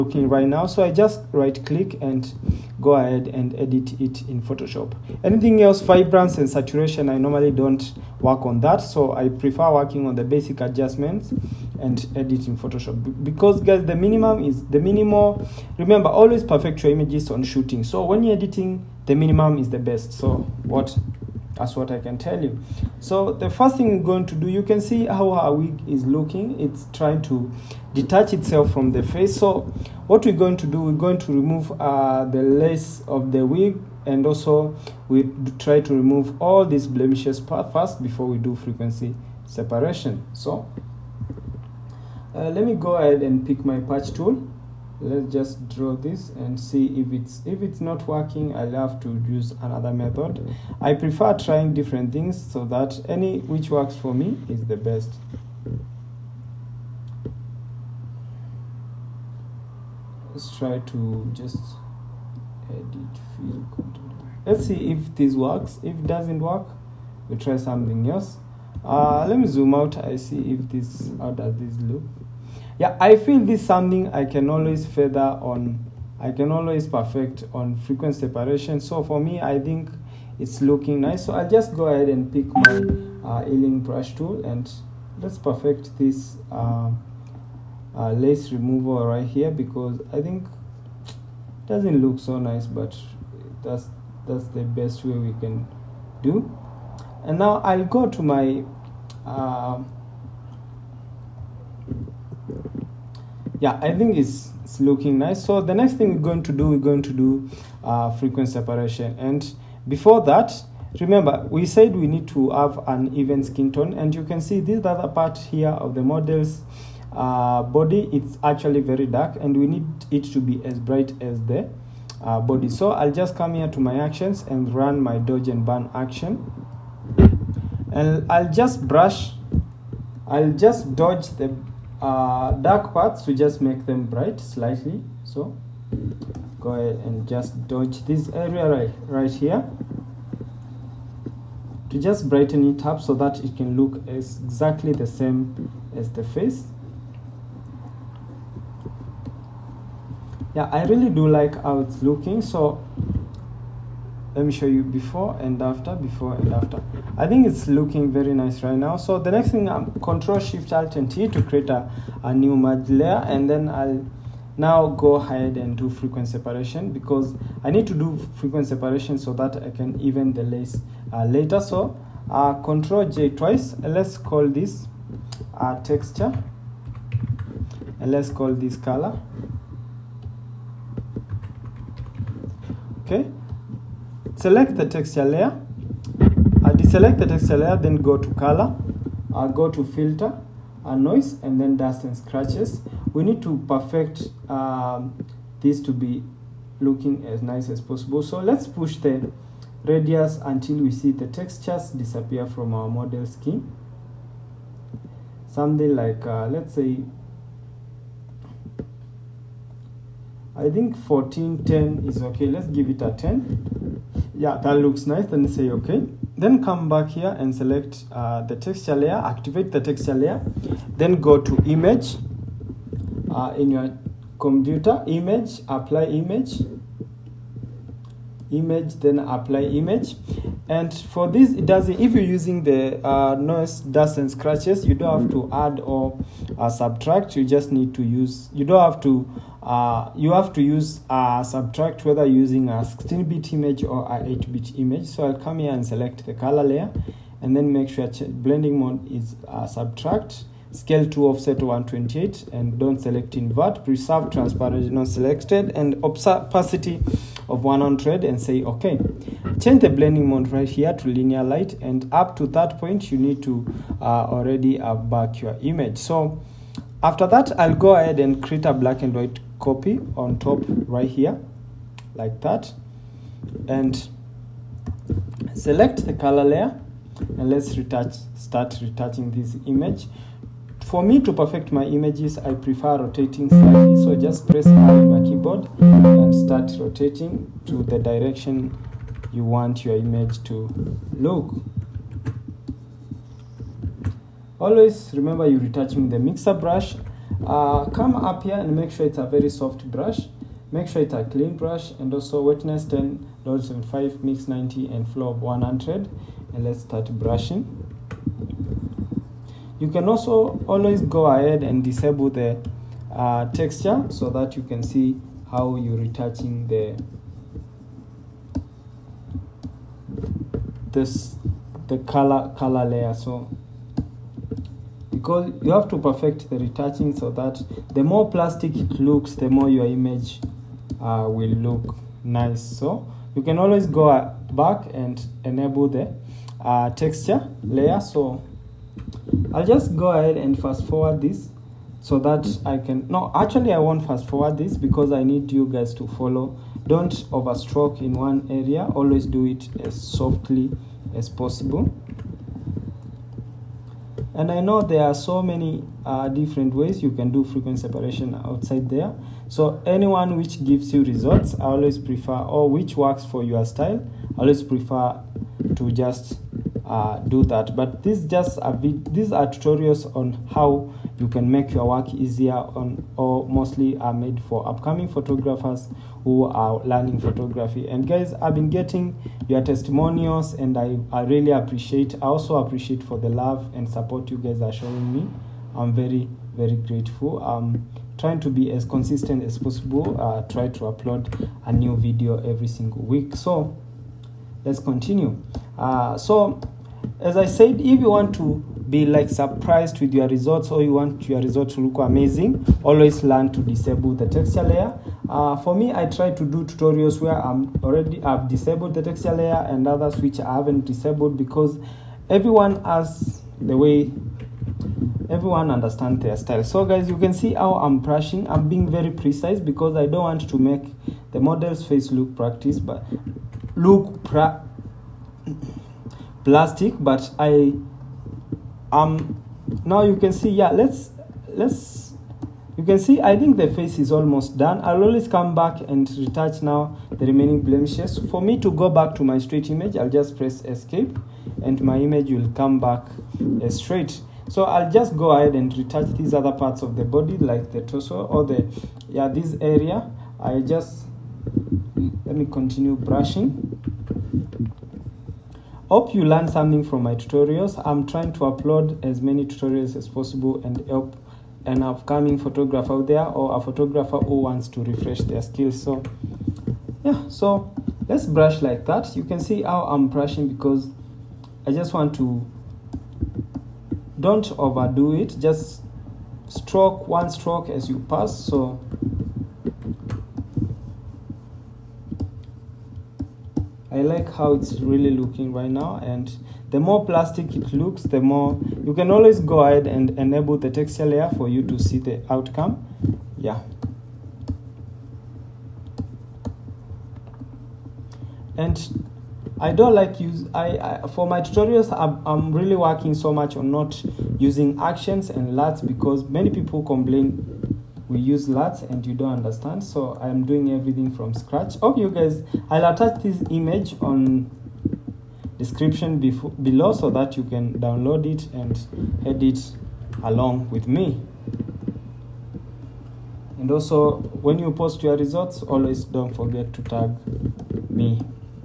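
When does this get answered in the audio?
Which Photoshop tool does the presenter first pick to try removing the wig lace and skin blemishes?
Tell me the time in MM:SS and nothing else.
00:43.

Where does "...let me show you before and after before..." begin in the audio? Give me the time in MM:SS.
02:34.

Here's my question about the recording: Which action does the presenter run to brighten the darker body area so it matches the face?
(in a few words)
Dodge and burn.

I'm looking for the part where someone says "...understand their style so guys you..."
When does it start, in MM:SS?
06:55.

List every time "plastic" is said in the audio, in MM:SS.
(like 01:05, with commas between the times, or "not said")
05:28, 07:06, 08:07.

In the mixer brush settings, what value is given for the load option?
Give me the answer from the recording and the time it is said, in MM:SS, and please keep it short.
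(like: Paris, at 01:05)
75, at 05:03.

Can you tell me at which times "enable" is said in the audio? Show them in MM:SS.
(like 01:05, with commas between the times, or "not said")
05:35, 08:10.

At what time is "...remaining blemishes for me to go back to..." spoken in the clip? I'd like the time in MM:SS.
07:17.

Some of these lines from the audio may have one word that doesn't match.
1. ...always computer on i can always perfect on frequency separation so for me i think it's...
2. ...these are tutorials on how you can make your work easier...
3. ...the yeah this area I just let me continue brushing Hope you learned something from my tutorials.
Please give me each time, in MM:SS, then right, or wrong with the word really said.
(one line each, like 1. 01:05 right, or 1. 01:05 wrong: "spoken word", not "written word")
1. 01:14 wrong: "further", not "computer"
2. 06:09 right
3. 07:28 right.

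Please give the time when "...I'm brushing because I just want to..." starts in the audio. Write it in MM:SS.
07:49.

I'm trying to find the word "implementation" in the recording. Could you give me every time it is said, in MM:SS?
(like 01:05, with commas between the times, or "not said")
not said.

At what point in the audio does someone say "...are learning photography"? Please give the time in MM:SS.
06:16.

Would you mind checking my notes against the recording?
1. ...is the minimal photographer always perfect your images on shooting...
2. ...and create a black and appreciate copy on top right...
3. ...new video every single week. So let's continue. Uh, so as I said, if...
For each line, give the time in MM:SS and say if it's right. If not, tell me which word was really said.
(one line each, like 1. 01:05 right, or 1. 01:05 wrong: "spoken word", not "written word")
1. 00:14 wrong: "remember", not "photographer"
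2. 04:28 wrong: "white", not "appreciate"
3. 06:31 right.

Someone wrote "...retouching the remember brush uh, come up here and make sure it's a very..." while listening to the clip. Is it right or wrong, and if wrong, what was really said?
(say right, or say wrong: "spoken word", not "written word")
wrong: "mixer", not "remember".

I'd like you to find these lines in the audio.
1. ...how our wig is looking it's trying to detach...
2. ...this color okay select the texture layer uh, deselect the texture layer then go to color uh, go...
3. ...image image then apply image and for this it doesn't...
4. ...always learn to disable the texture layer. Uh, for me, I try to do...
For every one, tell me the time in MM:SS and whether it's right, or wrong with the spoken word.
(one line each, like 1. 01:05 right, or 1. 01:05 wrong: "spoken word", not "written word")
1. 00:25 right
2. 02:58 right
3. 03:46 right
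4. 06:42 right.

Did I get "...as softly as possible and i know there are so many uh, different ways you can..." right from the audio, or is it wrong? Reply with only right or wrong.
right.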